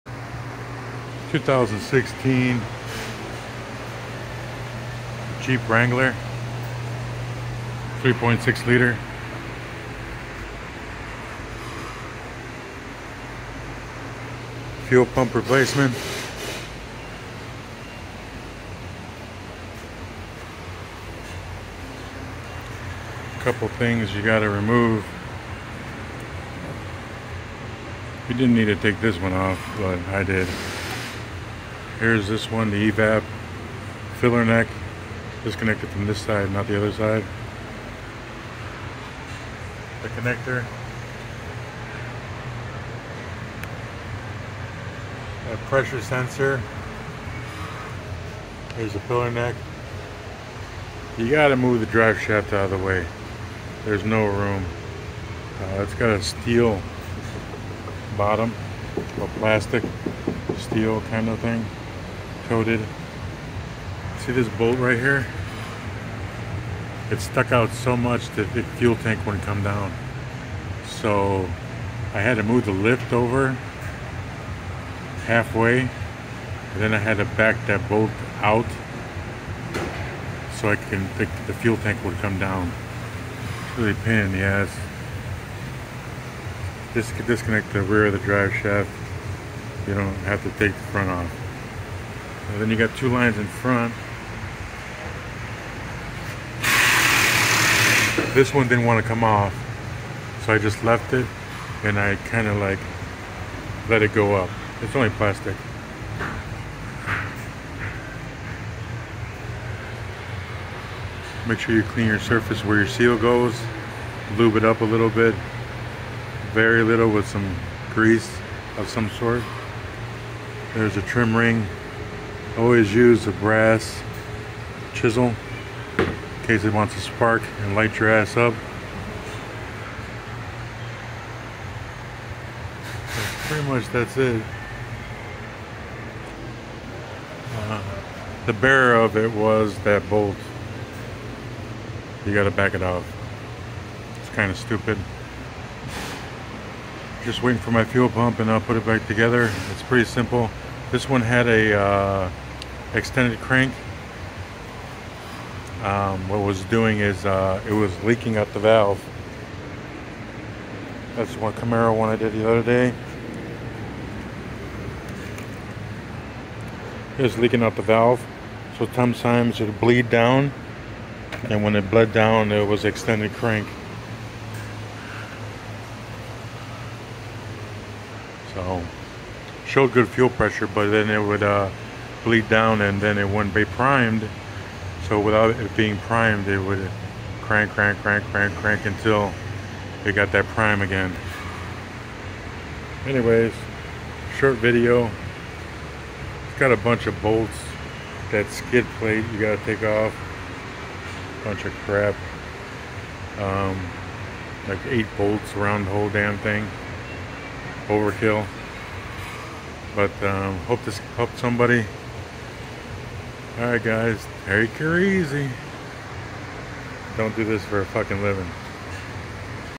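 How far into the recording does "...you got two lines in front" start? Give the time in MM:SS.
01:32.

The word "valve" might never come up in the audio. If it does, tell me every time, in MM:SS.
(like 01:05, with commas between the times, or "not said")
02:38, 02:47.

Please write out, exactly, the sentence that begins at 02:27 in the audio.
Just waiting for my fuel pump and I'll put it back together.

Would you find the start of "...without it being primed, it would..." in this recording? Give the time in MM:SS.
03:05.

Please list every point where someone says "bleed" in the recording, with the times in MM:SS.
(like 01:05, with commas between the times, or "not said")
02:49, 03:02.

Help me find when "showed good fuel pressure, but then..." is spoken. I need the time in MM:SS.
02:59.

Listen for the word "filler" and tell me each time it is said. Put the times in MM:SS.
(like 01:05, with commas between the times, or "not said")
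00:34, 00:49.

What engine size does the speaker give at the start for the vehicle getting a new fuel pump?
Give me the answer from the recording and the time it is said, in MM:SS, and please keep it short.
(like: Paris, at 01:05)
3.6 liter, at 00:08.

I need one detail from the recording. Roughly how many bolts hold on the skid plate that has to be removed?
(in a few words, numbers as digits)
8.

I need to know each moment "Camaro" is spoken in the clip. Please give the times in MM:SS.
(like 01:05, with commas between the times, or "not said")
02:41.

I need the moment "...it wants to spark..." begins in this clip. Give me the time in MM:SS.
02:06.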